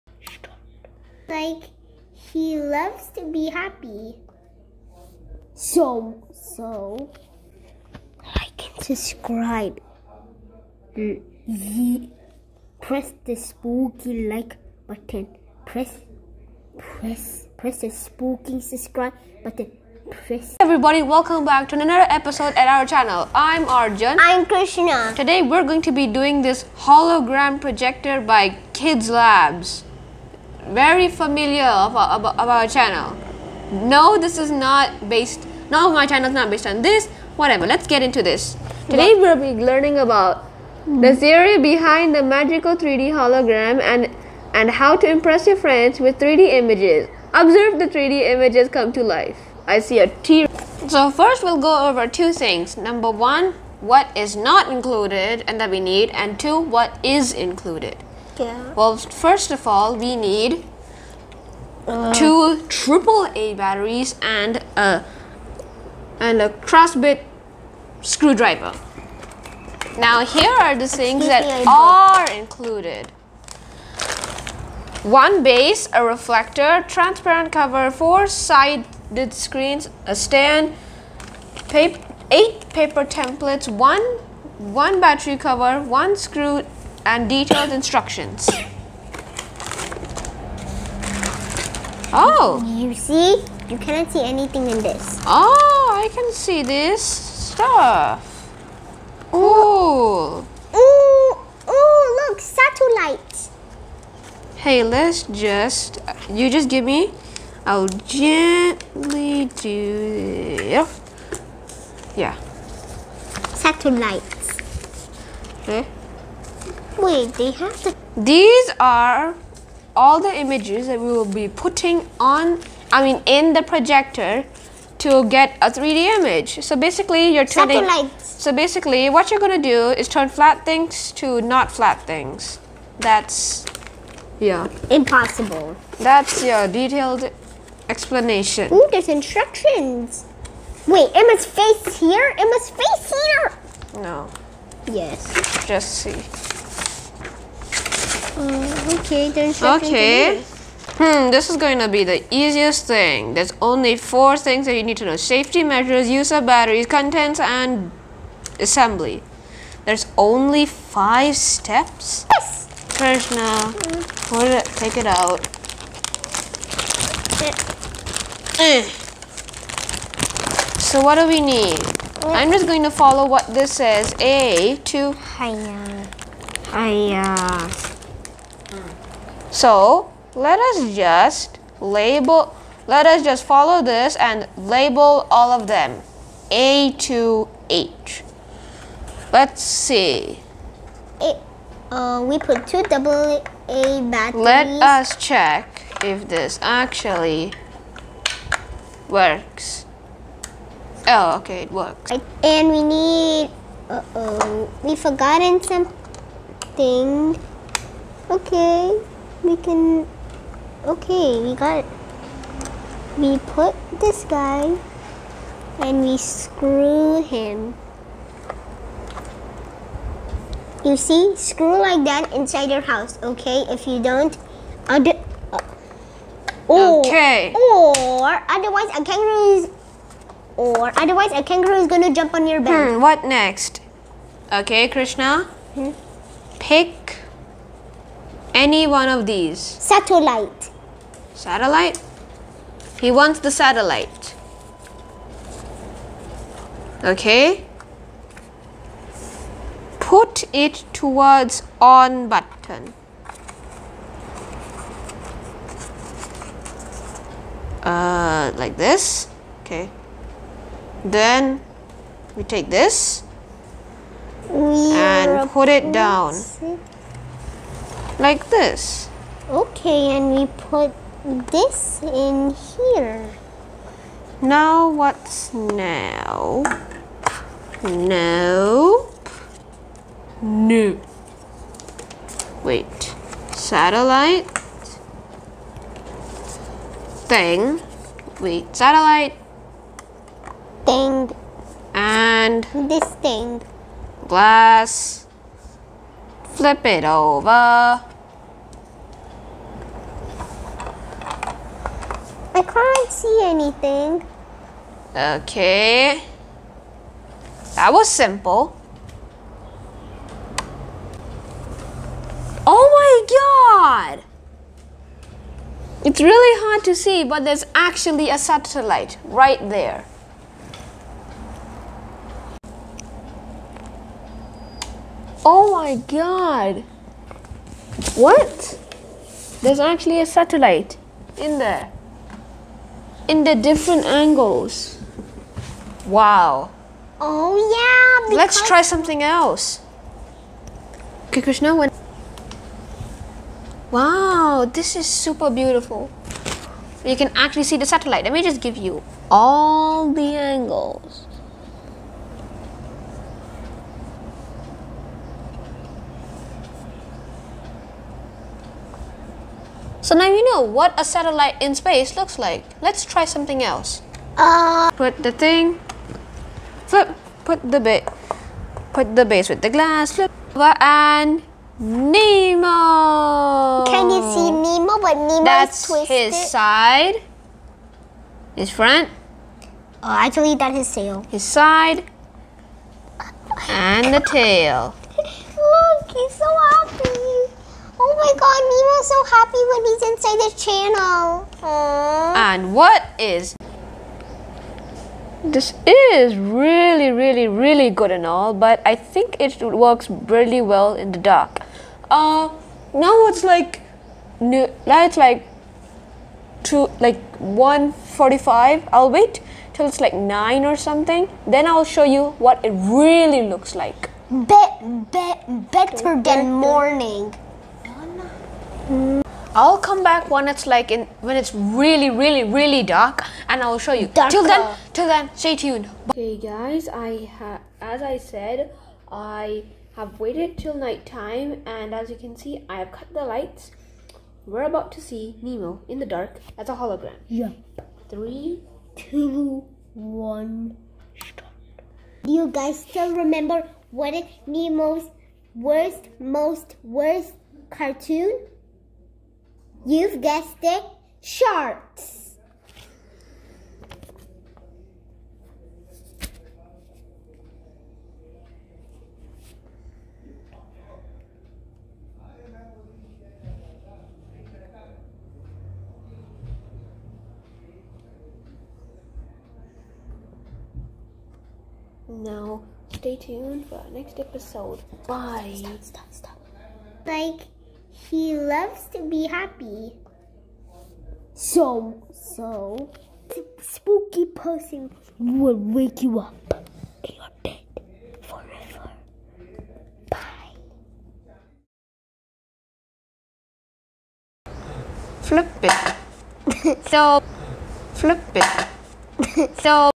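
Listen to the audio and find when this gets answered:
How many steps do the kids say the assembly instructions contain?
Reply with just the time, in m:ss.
2:40.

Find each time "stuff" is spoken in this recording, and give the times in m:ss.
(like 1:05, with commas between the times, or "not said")
1:37.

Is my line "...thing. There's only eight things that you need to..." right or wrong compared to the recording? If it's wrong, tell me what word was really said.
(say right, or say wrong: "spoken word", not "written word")
wrong: "four", not "eight".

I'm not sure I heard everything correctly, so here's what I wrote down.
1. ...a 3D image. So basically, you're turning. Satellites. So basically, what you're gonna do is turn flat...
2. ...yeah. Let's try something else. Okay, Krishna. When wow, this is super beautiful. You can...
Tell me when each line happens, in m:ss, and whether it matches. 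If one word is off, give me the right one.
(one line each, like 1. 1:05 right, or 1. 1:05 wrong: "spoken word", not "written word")
1. 2:05 right
2. 5:37 right.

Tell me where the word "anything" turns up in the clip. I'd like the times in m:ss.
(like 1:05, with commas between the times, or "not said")
1:34, 5:03.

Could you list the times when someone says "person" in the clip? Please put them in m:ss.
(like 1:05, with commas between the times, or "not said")
8:04.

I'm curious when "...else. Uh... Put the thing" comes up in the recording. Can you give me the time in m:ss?
6:03.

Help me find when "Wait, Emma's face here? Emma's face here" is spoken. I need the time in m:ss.
2:20.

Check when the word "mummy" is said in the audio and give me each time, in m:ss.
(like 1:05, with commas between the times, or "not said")
not said.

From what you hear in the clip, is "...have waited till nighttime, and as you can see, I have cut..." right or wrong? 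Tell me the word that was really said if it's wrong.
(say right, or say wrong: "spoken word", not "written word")
right.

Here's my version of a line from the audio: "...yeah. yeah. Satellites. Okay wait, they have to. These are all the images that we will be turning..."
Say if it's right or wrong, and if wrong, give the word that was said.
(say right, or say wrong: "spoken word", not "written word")
wrong: "putting", not "turning".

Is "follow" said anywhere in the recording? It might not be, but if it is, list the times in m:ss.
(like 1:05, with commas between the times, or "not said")
2:52, 3:03.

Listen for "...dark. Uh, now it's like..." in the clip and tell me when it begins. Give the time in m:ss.
6:41.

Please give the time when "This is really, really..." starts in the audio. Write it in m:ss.
6:35.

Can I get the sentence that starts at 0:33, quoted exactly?
No, this is not based, no, my channel is not based on this, whatever.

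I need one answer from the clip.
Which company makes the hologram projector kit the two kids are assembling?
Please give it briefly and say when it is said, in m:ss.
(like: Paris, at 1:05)
Kids Labs, at 0:28.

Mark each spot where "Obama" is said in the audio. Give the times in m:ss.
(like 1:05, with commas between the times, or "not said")
not said.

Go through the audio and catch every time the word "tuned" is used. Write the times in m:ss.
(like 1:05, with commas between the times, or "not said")
7:05, 7:53.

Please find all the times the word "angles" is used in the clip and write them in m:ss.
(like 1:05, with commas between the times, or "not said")
5:34, 5:50.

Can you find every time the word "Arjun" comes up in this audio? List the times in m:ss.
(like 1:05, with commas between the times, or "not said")
0:23.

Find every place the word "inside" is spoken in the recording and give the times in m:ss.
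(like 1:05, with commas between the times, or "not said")
3:42, 6:30.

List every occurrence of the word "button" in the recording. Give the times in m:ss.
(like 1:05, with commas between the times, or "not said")
0:14, 0:19, 4:12.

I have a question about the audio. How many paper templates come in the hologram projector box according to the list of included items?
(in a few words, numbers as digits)
8.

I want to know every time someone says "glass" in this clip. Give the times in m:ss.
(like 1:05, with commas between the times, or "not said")
4:54, 6:09.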